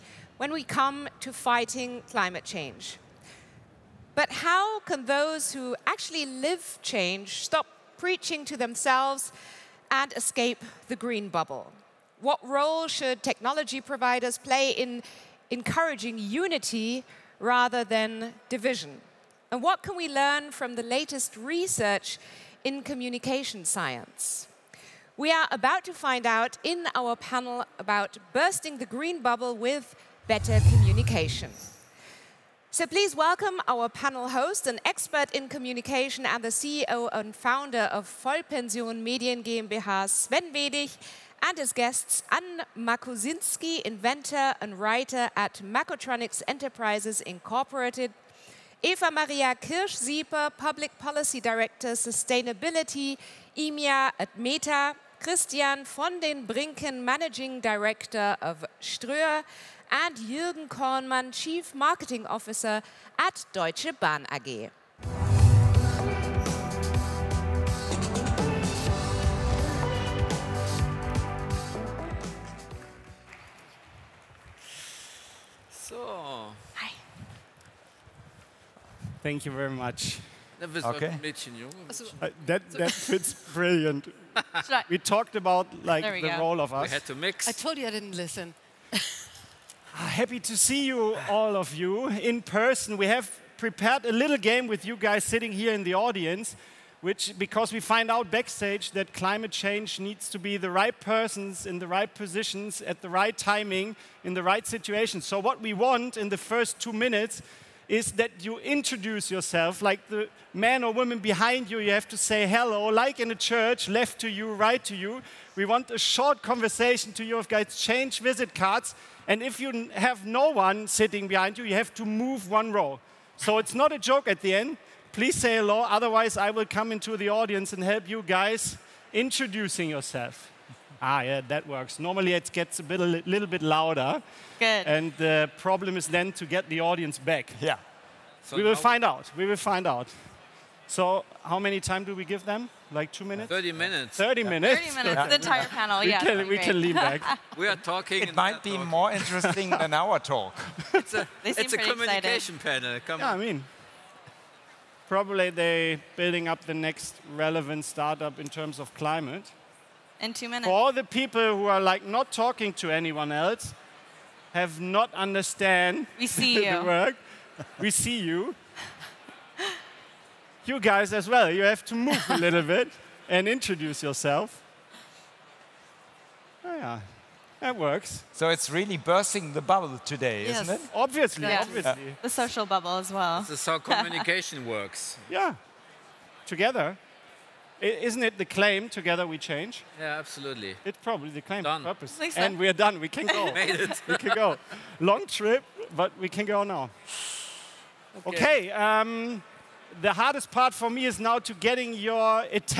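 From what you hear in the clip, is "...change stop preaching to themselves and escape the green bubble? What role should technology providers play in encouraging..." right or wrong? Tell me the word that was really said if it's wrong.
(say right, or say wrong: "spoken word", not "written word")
right.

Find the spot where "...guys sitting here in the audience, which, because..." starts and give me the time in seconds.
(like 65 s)
94 s.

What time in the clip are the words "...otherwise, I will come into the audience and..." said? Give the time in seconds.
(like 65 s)
125 s.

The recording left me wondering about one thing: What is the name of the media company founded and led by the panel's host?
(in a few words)
Vollpension Medien GmbH.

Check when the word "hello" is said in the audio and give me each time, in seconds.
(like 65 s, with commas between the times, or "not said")
112 s, 125 s.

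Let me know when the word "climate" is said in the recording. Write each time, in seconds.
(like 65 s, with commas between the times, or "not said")
2 s, 99 s, 158 s.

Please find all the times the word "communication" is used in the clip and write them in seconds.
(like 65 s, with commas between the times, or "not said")
22 s, 30 s, 35 s, 151 s, 183 s.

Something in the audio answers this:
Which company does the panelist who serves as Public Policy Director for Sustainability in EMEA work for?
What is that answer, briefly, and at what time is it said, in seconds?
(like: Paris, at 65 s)
Meta, at 54 s.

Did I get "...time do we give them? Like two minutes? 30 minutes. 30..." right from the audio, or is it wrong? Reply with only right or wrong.
right.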